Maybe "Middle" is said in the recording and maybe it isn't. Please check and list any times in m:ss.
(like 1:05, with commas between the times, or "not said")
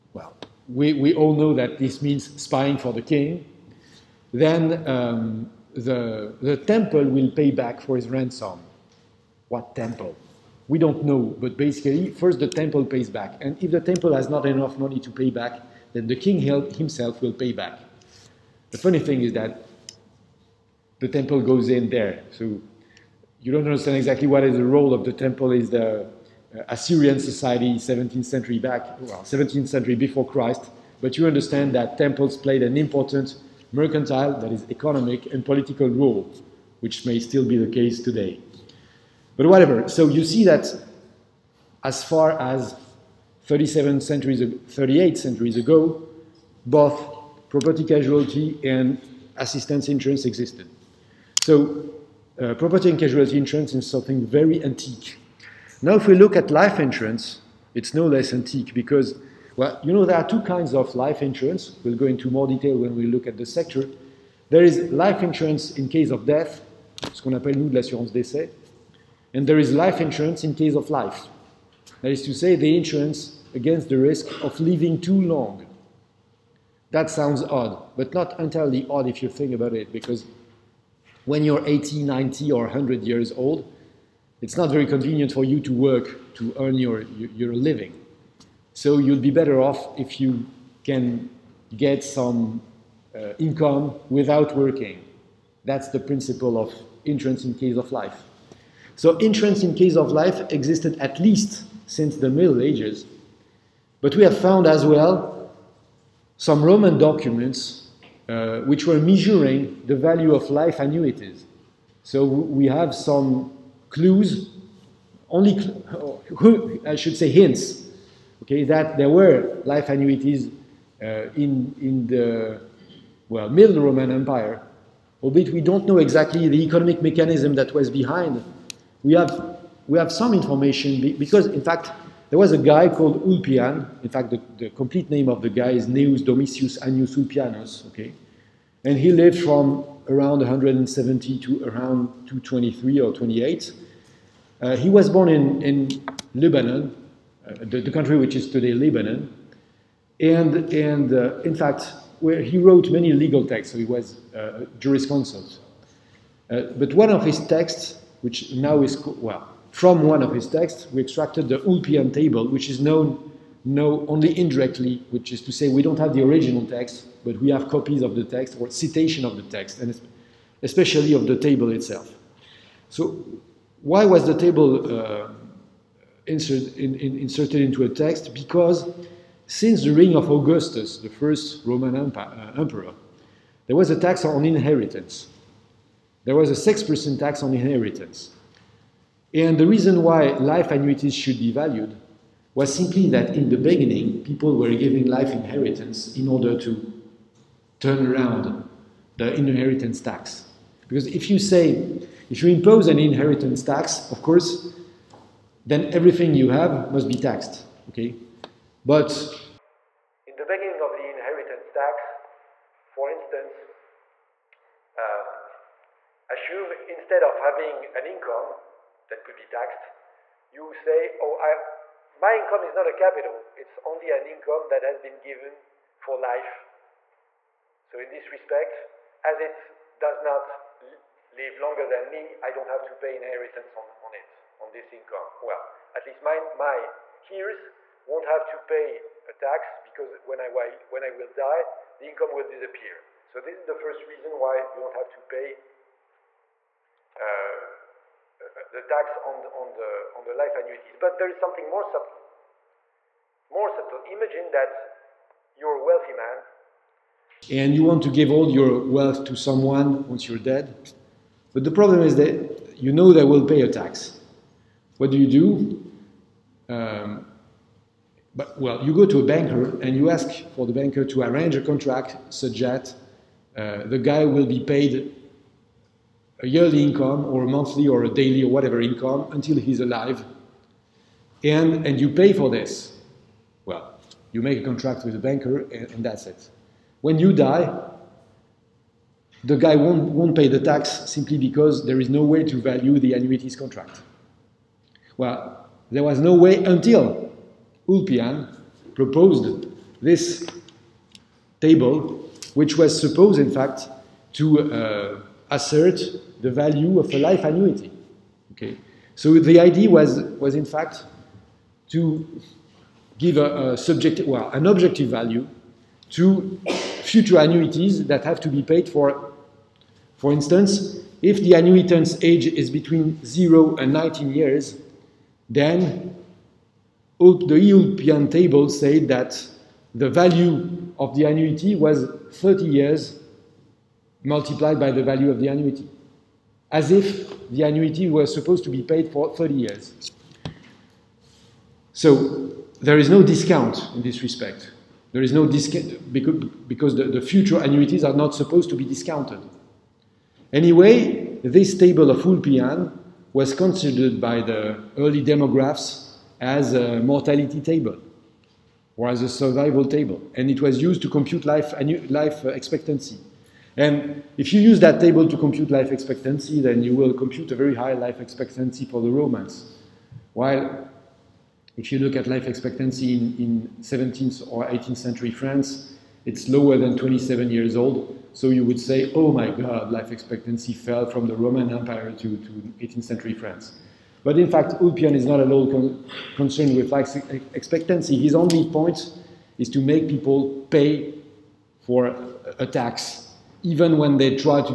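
1:42, 2:03.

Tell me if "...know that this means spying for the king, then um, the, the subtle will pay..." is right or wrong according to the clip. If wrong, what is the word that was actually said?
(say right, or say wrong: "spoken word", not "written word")
wrong: "temple", not "subtle".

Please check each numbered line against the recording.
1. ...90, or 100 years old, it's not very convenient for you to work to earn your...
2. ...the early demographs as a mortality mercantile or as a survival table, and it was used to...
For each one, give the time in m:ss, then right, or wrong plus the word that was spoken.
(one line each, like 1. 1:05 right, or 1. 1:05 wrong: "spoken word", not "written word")
1. 1:22 right
2. 5:54 wrong: "table", not "mercantile".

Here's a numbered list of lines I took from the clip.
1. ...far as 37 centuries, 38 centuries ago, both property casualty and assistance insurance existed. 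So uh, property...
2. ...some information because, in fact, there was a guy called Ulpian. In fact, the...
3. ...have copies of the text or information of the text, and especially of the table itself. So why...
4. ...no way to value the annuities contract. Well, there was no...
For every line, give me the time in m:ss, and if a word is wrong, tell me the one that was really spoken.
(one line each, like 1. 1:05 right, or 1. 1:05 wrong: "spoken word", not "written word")
1. 0:42 right
2. 2:10 right
3. 2:47 wrong: "citation", not "information"
4. 4:52 right.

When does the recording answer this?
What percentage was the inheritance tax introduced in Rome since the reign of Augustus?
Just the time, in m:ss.
3:06.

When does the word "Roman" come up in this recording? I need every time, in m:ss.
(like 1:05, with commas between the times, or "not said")
1:46, 2:03, 3:01, 6:09, 6:21.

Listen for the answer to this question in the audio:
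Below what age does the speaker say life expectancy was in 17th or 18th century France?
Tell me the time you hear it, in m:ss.
6:16.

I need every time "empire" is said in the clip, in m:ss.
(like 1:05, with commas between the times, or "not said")
2:04, 3:01, 6:21.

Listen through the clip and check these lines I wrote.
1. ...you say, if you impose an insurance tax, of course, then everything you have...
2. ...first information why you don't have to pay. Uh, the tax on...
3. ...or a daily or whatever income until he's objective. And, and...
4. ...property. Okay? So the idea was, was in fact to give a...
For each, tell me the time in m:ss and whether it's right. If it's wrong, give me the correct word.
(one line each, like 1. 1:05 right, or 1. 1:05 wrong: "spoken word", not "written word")
1. 3:21 wrong: "inheritance", not "insurance"
2. 4:03 wrong: "reason", not "information"
3. 4:37 wrong: "alive", not "objective"
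4. 5:07 wrong: "annuity", not "property".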